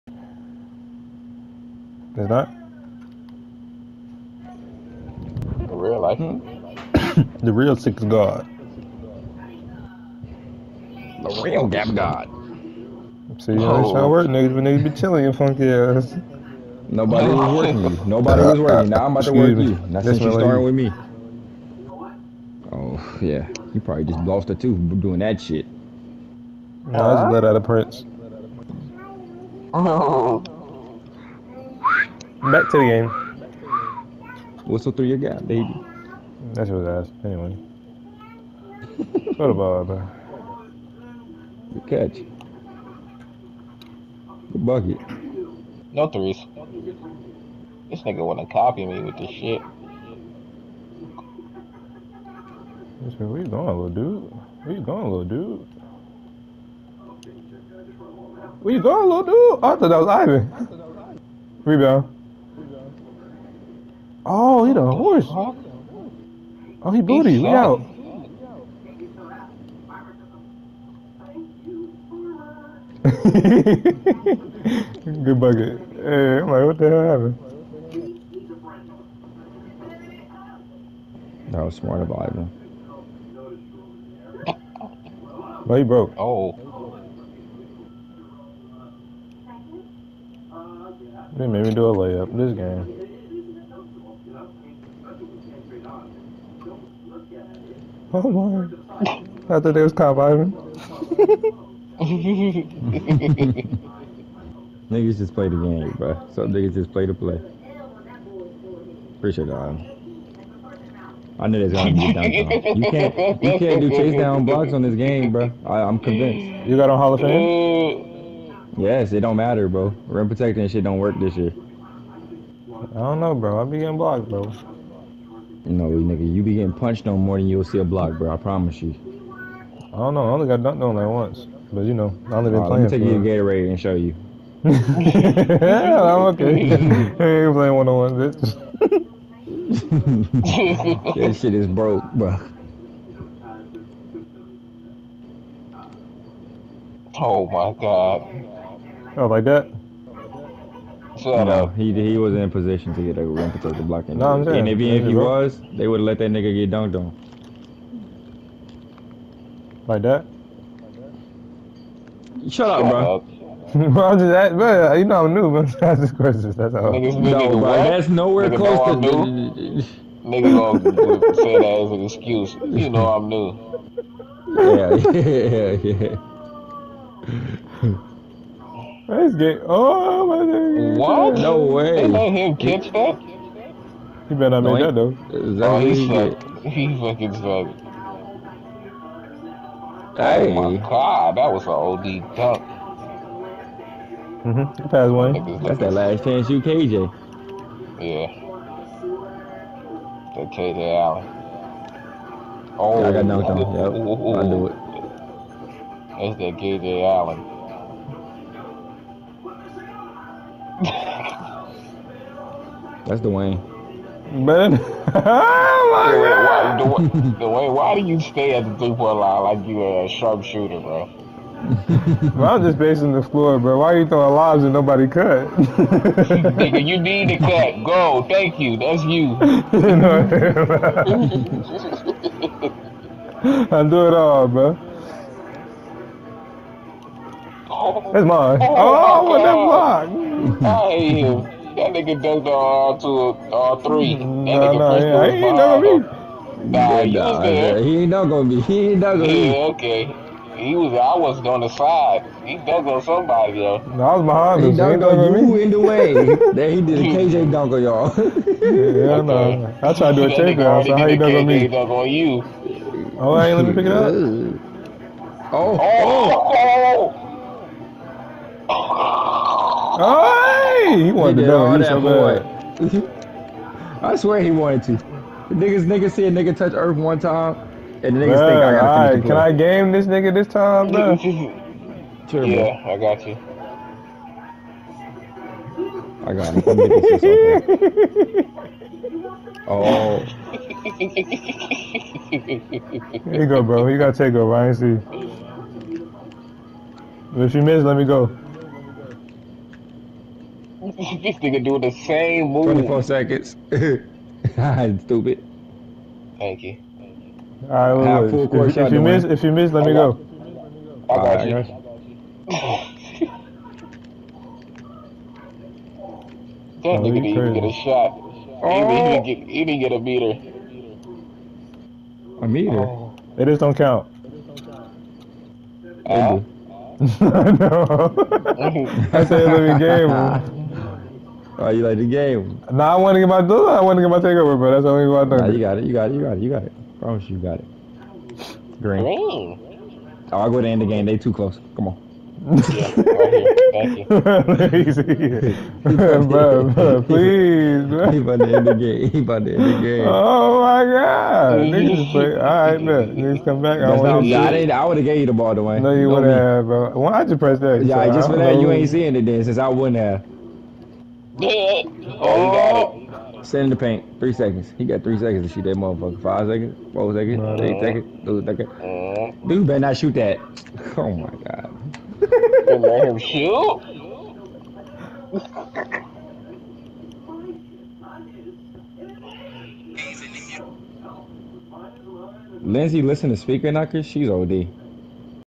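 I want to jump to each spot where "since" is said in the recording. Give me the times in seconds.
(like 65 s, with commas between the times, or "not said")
20 s, 359 s.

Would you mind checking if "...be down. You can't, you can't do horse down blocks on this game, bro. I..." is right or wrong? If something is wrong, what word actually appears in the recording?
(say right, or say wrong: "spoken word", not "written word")
wrong: "chase", not "horse".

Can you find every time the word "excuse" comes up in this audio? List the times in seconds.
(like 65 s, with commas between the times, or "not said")
172 s.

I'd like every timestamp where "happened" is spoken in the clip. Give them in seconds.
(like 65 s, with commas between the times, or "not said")
77 s.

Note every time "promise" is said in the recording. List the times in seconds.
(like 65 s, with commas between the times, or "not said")
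128 s, 336 s.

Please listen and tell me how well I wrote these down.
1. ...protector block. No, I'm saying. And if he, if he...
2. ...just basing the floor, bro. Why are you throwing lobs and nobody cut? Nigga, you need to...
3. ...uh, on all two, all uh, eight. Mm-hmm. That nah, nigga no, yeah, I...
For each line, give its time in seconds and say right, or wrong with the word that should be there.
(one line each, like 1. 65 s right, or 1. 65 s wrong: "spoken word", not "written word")
1. 153 s right
2. 222 s right
3. 242 s wrong: "three", not "eight".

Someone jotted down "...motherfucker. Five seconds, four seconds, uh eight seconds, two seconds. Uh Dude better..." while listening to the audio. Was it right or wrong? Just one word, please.
right.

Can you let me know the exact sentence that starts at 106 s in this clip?
Some niggas just play the play.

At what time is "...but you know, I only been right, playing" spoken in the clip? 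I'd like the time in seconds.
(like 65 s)
131 s.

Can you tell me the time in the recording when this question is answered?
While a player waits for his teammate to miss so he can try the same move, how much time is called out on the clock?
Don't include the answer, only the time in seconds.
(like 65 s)
302 s.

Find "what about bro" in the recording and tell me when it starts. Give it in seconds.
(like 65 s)
39 s.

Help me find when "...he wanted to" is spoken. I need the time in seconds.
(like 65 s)
274 s.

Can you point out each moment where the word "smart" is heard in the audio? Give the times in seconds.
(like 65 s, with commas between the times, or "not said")
81 s.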